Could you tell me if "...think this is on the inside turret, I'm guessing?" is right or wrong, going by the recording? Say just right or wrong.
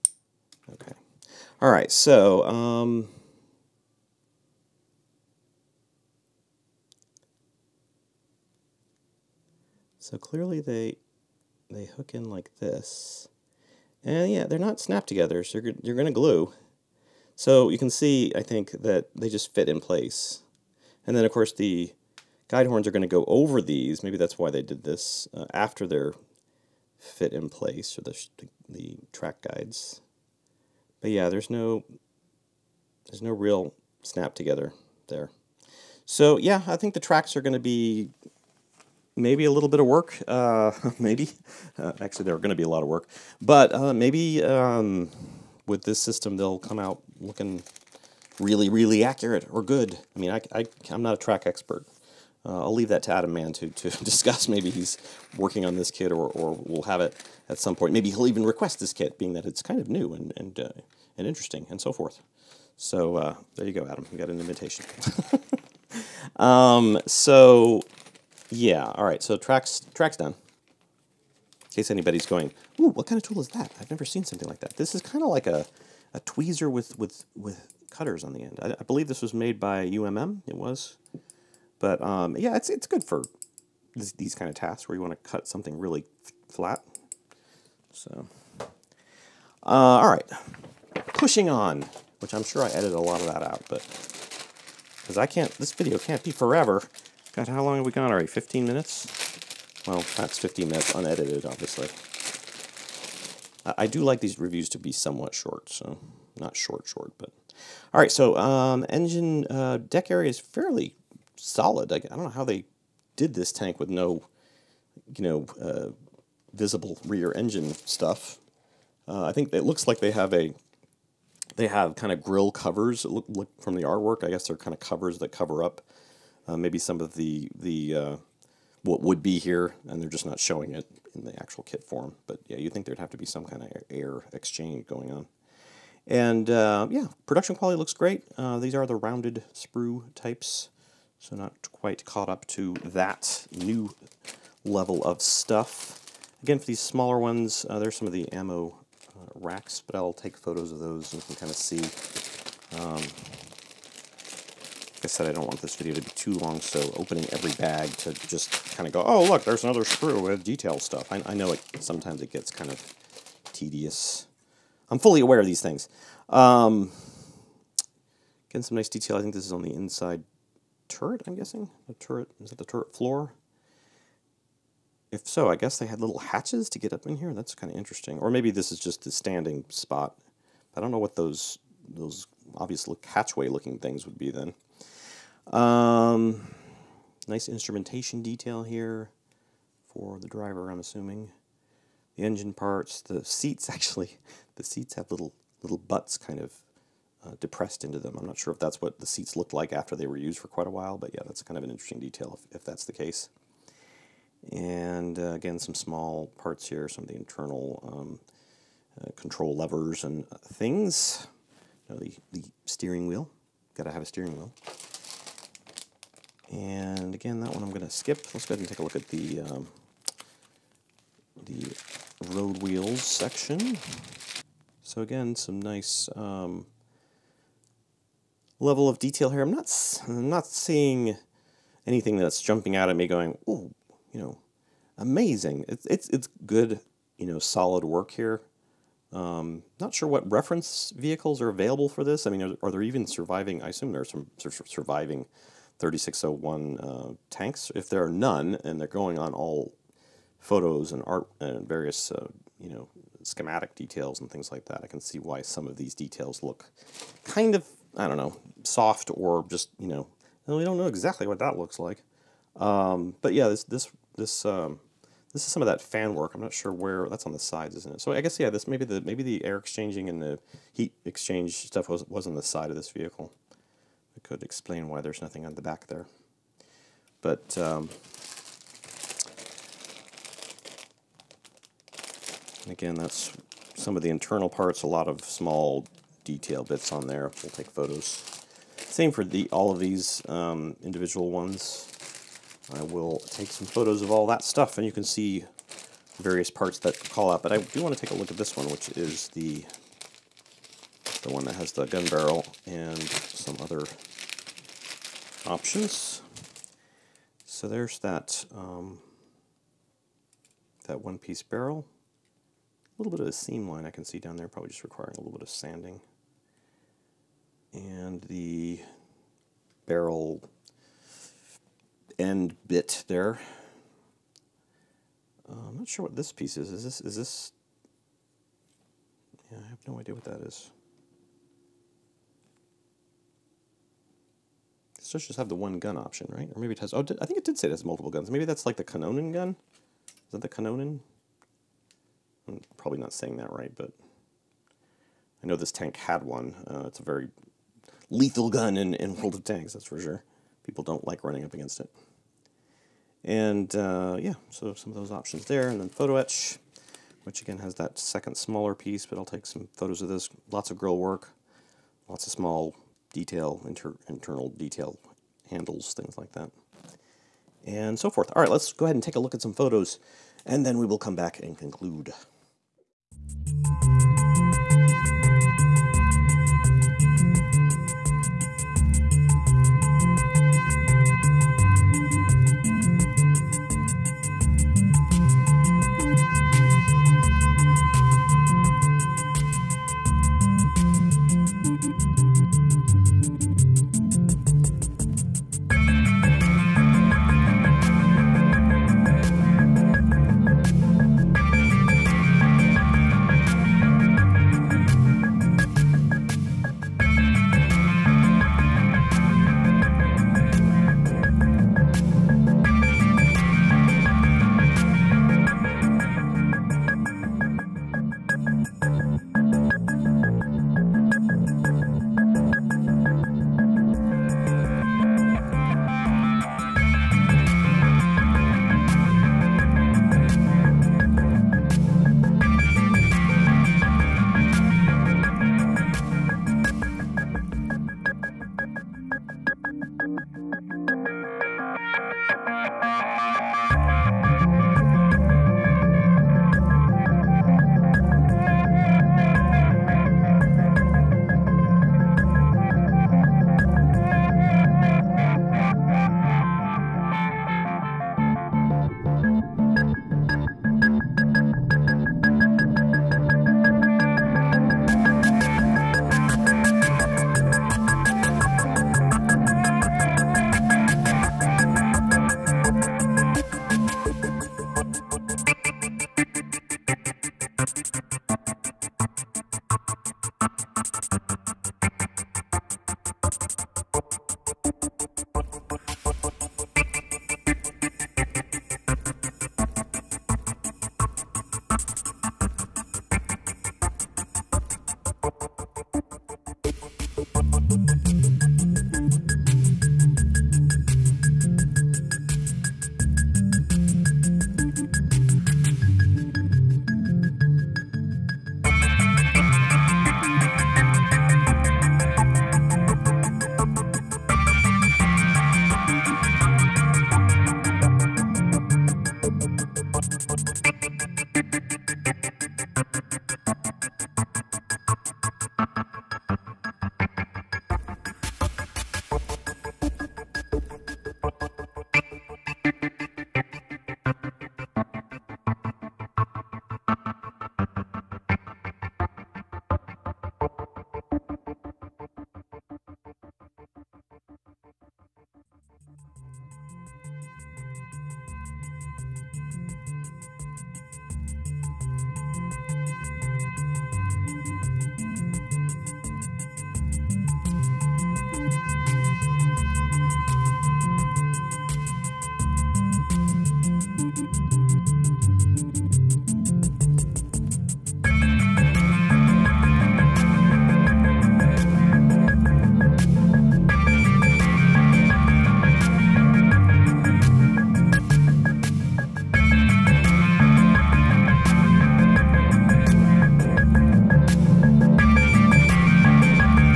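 right.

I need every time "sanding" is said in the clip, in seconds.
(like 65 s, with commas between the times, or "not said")
315 s.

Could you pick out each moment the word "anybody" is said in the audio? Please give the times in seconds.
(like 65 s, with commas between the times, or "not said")
71 s.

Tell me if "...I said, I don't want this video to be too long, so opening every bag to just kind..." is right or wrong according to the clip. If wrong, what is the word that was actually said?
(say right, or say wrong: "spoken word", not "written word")
right.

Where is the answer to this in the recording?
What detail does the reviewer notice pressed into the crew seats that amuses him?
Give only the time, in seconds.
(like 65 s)
195 s.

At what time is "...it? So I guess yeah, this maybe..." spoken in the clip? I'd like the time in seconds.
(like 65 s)
267 s.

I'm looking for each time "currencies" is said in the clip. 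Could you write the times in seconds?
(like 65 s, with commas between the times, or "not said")
not said.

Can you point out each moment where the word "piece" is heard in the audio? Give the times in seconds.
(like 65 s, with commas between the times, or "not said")
311 s, 326 s, 358 s.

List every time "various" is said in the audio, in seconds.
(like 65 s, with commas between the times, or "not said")
251 s, 296 s.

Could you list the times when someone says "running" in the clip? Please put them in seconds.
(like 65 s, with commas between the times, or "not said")
351 s.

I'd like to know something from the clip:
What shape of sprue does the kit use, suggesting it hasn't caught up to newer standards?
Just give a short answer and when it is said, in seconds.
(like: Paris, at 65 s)
rounded, at 138 s.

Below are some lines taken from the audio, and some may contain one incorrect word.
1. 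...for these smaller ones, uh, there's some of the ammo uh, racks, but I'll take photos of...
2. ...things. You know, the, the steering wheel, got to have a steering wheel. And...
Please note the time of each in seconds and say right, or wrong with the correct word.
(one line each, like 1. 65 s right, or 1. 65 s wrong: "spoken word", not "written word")
1. 146 s right
2. 210 s right.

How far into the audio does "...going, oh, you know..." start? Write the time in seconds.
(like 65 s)
233 s.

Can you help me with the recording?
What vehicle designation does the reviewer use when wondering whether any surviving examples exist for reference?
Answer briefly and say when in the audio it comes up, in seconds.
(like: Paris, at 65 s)
3601, at 245 s.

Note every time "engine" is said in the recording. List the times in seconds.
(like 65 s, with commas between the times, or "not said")
108 s, 117 s, 192 s.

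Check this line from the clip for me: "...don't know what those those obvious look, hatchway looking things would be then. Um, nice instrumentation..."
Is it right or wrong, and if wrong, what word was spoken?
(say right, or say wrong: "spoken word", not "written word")
right.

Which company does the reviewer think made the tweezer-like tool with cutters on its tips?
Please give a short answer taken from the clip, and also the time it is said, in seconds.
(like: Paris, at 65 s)
UMM, at 79 s.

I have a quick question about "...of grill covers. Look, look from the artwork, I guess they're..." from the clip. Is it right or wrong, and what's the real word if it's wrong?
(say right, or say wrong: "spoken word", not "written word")
right.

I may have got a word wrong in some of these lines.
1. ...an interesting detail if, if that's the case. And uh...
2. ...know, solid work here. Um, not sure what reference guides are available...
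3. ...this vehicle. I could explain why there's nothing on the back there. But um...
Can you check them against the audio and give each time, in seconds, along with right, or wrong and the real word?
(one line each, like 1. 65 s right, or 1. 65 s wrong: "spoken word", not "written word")
1. 201 s right
2. 237 s wrong: "vehicles", not "guides"
3. 272 s right.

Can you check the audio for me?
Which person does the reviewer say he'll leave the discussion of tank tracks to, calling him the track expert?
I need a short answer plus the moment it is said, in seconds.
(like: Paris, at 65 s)
Adam Mann, at 53 s.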